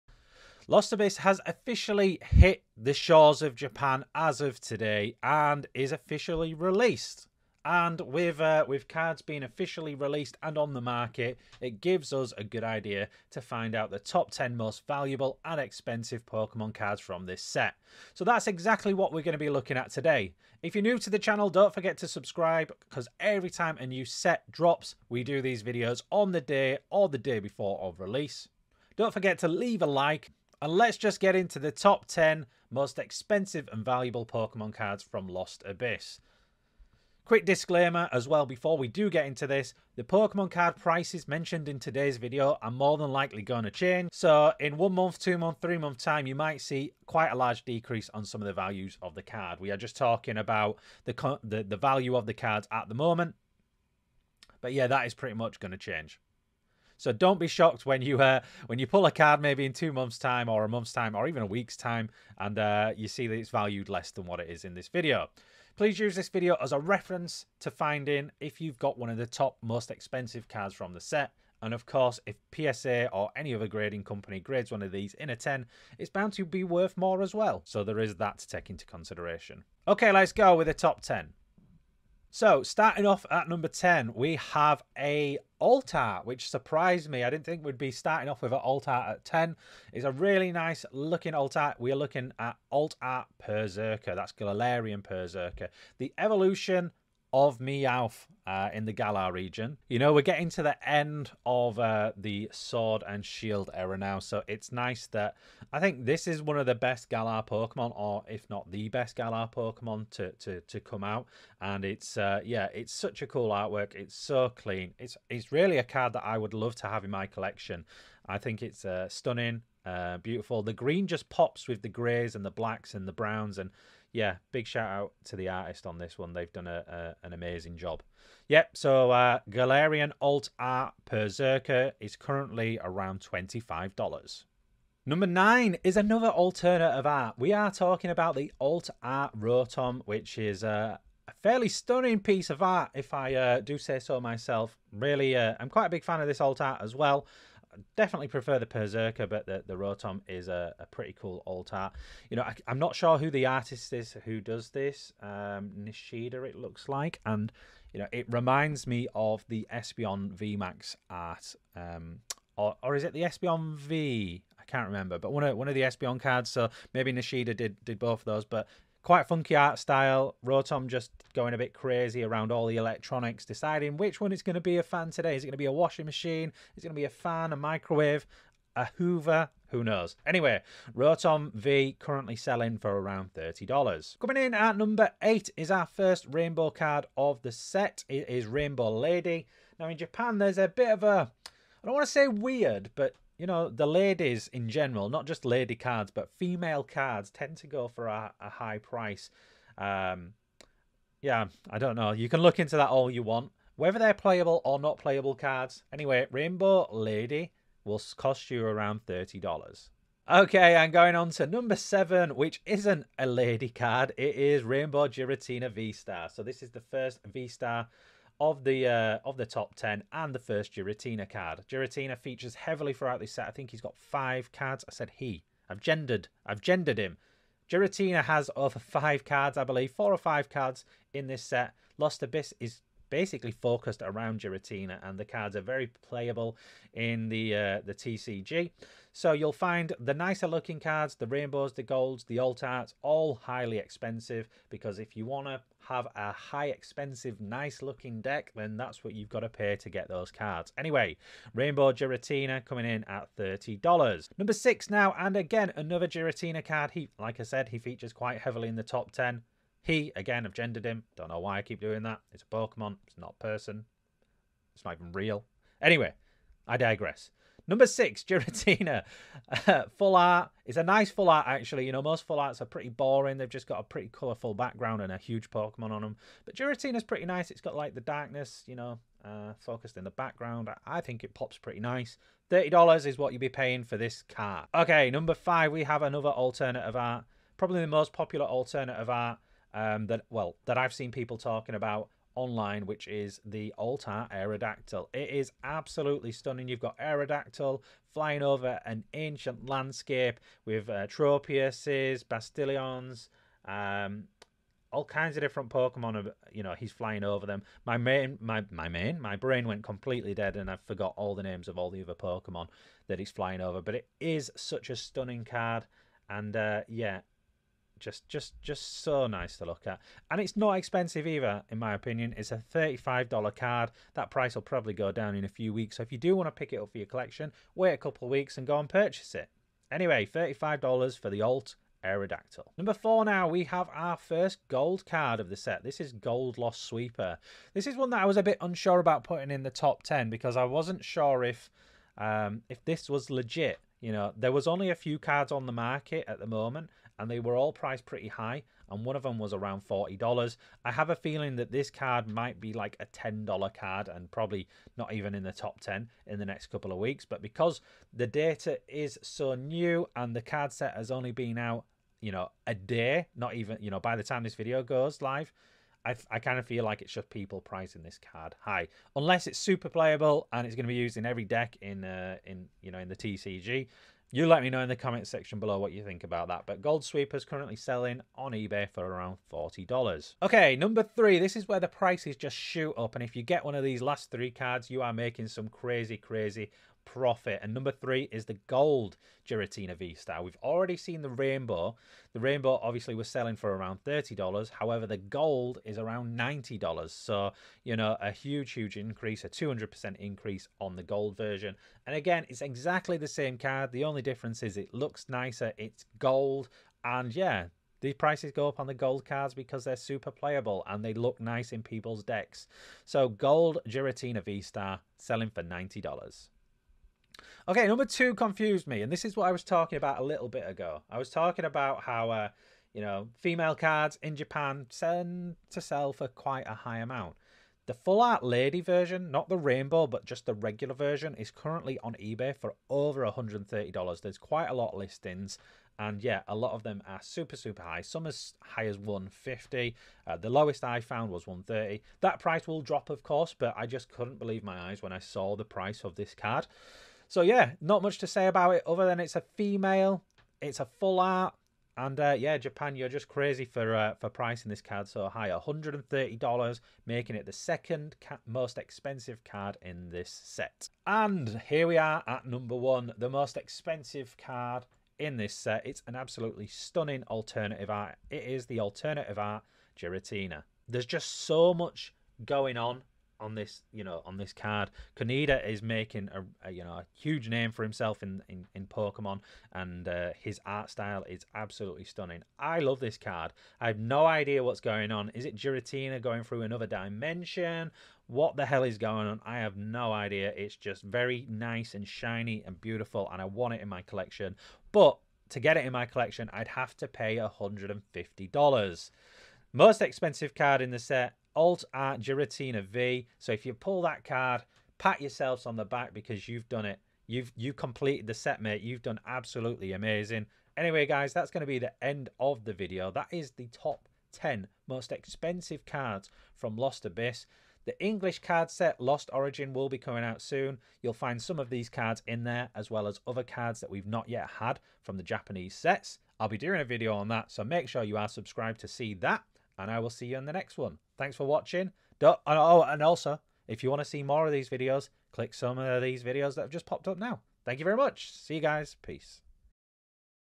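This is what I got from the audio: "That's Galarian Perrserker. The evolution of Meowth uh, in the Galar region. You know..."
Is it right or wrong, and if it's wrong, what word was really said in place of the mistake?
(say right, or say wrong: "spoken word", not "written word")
right.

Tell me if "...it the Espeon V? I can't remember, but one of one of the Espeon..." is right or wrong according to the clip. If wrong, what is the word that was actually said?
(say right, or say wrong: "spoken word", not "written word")
right.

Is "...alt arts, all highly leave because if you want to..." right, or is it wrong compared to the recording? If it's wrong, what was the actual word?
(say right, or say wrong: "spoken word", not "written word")
wrong: "expensive", not "leave".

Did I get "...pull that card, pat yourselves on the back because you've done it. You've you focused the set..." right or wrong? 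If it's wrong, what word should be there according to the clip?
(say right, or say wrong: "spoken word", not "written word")
wrong: "completed", not "focused".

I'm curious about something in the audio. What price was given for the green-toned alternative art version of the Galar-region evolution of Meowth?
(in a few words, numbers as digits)
$25.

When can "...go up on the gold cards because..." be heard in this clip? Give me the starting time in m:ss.
6:48.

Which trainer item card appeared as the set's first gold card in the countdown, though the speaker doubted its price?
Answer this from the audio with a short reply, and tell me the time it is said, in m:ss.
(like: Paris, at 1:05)
Lost Sweeper, at 5:36.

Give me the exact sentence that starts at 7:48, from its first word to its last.
It is the alternative art Giratina.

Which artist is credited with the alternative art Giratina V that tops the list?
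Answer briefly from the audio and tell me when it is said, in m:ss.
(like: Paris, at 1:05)
Kaneda, at 7:55.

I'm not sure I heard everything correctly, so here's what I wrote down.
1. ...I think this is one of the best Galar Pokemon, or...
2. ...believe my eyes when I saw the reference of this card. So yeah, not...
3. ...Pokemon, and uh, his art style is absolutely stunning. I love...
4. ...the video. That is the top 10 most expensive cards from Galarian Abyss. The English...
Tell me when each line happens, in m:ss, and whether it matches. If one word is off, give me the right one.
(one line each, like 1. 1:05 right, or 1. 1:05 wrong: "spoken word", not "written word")
1. 1:45 right
2. 7:24 wrong: "price", not "reference"
3. 7:58 right
4. 8:32 wrong: "Lost", not "Galarian".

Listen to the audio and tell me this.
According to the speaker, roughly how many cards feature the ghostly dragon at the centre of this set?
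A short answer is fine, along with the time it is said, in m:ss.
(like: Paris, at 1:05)
4 or 5, at 3:49.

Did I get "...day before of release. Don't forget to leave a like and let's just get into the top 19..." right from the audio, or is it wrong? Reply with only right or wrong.
wrong.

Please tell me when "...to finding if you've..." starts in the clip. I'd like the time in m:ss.
1:07.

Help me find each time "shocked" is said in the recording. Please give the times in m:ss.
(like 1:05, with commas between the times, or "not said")
0:57.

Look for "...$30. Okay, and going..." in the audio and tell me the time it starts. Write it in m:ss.
3:29.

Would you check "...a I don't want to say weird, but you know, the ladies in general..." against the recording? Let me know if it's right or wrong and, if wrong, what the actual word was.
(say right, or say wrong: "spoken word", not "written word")
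right.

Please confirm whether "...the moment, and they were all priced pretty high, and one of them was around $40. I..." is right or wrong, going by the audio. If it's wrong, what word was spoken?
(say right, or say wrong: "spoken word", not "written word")
right.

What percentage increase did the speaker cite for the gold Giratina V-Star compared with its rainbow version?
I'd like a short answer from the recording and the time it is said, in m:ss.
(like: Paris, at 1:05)
200%, at 6:39.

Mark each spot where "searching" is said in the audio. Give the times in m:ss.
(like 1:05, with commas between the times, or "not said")
not said.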